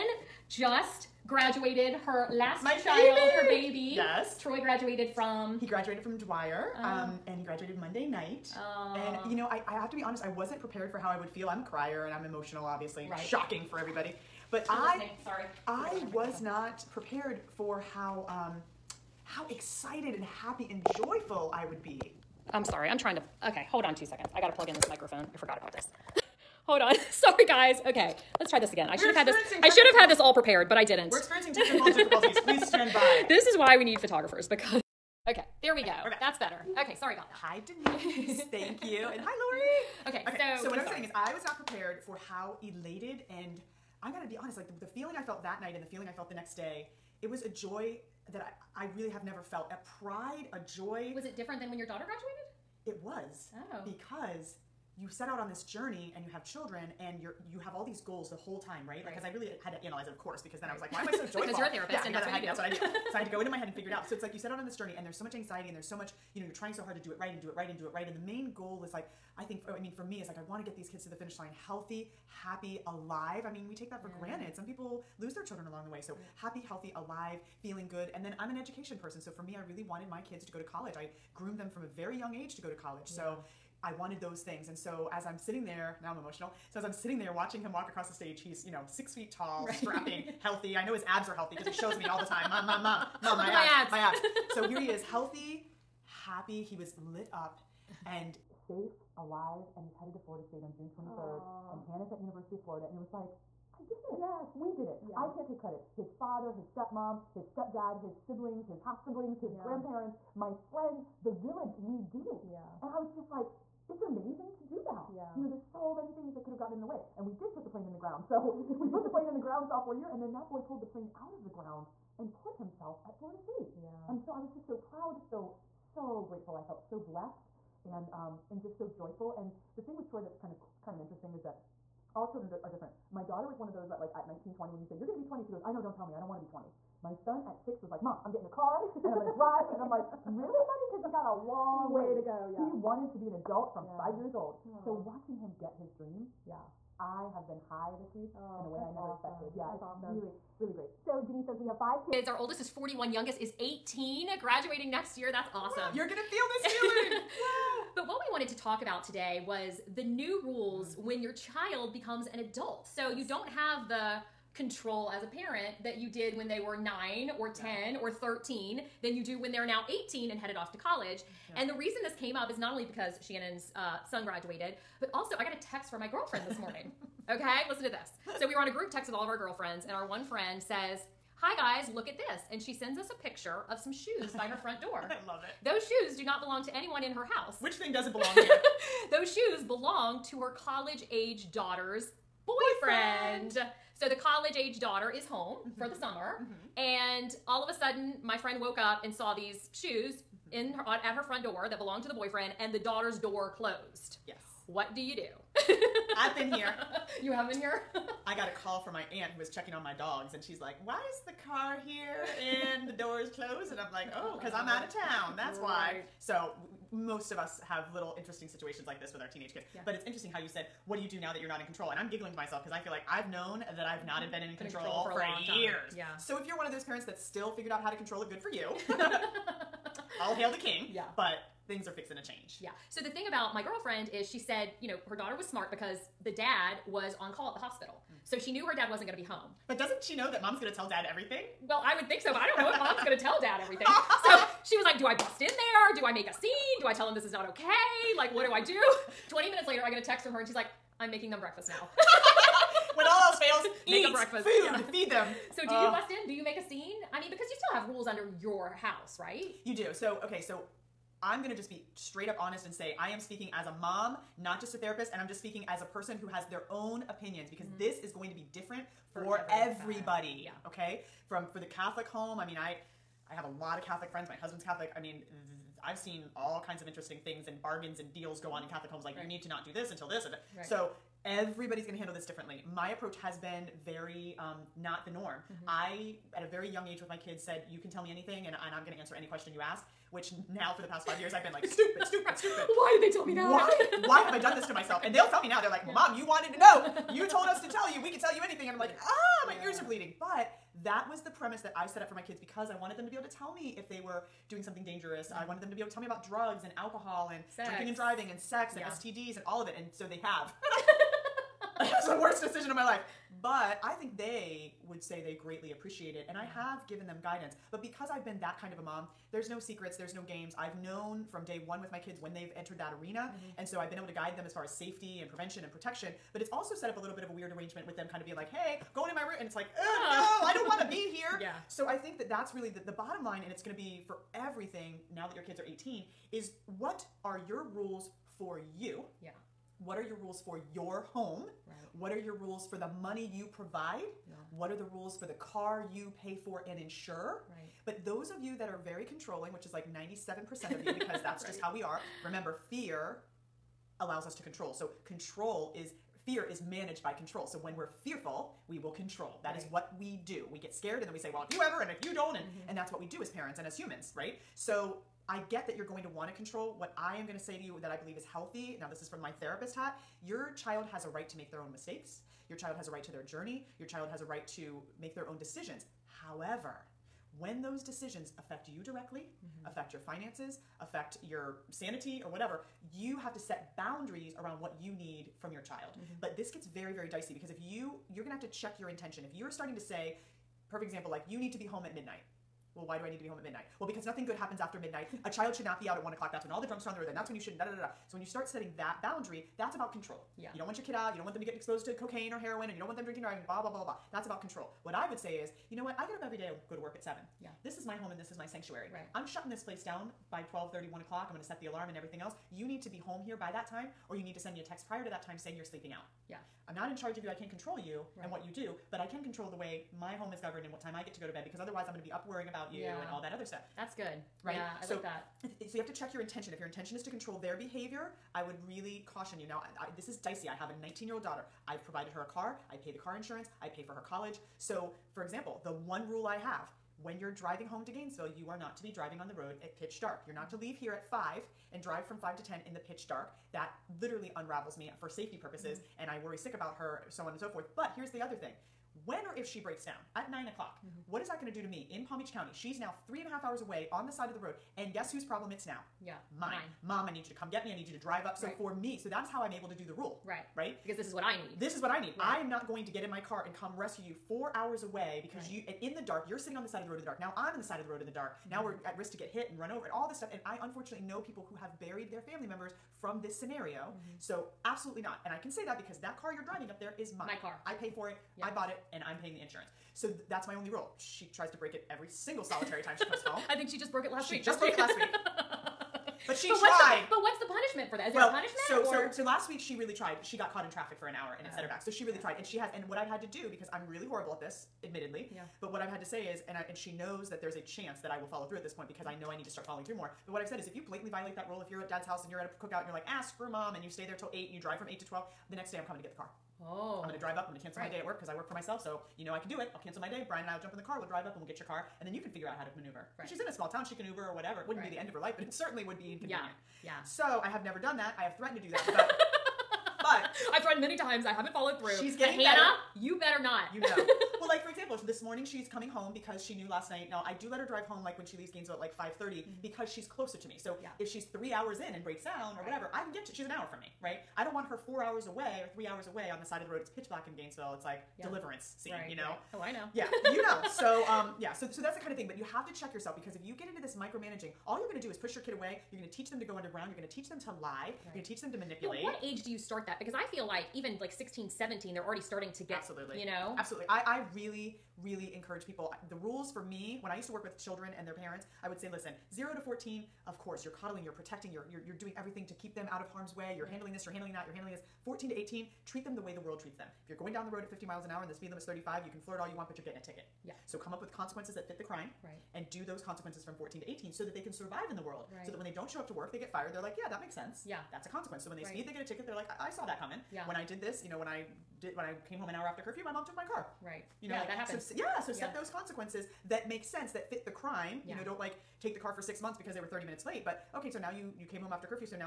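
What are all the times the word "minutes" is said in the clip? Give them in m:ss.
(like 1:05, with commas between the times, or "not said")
4:09, 9:50.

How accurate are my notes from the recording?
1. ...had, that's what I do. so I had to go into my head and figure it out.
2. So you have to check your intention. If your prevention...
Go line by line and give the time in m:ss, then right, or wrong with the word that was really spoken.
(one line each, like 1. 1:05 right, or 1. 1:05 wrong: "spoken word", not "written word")
1. 1:02 right
2. 7:05 wrong: "intention", not "prevention".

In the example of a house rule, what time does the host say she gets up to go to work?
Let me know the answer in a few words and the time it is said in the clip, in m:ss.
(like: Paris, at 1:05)
7, at 6:47.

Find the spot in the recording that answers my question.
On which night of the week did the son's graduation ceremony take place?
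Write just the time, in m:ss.
0:07.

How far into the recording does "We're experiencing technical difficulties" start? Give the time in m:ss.
0:31.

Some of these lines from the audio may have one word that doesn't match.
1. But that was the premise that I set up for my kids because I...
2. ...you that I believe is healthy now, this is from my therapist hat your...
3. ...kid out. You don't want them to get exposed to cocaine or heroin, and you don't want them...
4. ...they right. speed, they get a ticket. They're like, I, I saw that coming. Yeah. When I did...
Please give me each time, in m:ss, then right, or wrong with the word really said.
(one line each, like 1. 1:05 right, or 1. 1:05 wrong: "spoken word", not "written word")
1. 5:00 right
2. 6:07 right
3. 6:40 right
4. 9:38 right.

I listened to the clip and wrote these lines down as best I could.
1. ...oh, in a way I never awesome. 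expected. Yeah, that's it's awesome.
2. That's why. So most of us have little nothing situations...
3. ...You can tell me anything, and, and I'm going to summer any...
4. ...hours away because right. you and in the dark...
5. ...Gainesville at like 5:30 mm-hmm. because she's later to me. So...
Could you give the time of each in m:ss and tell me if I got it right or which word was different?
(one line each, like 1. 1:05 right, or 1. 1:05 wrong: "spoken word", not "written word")
1. 2:28 right
2. 3:35 wrong: "interesting", not "nothing"
3. 4:47 wrong: "answer", not "summer"
4. 7:44 right
5. 8:48 wrong: "closer", not "later".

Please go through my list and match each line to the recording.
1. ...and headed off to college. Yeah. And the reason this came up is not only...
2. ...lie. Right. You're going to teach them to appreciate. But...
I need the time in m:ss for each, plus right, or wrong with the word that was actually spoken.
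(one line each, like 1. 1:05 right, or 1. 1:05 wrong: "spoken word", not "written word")
1. 2:50 right
2. 9:07 wrong: "manipulate", not "appreciate".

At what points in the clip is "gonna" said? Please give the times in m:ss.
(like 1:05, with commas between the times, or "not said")
0:44, 2:15, 2:36, 4:21.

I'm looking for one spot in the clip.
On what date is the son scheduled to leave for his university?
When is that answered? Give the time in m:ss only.
1:40.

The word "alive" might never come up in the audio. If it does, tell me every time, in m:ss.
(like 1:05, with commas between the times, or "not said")
1:12, 1:16, 1:39.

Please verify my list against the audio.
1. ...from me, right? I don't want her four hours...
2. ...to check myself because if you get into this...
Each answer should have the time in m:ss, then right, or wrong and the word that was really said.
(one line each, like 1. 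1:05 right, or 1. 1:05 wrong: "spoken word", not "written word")
1. 8:53 right
2. 9:02 wrong: "yourself", not "myself".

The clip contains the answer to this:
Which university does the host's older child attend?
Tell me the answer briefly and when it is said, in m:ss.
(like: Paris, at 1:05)
University of Florida, at 1:42.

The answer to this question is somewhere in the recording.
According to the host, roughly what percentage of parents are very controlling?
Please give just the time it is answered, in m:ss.
5:49.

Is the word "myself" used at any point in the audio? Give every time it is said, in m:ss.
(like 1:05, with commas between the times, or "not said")
3:42, 4:54, 8:28.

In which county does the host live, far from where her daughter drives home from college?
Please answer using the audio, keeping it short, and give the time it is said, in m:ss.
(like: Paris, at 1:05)
Palm Beach County, at 7:32.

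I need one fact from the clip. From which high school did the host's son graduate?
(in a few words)
Dwyer.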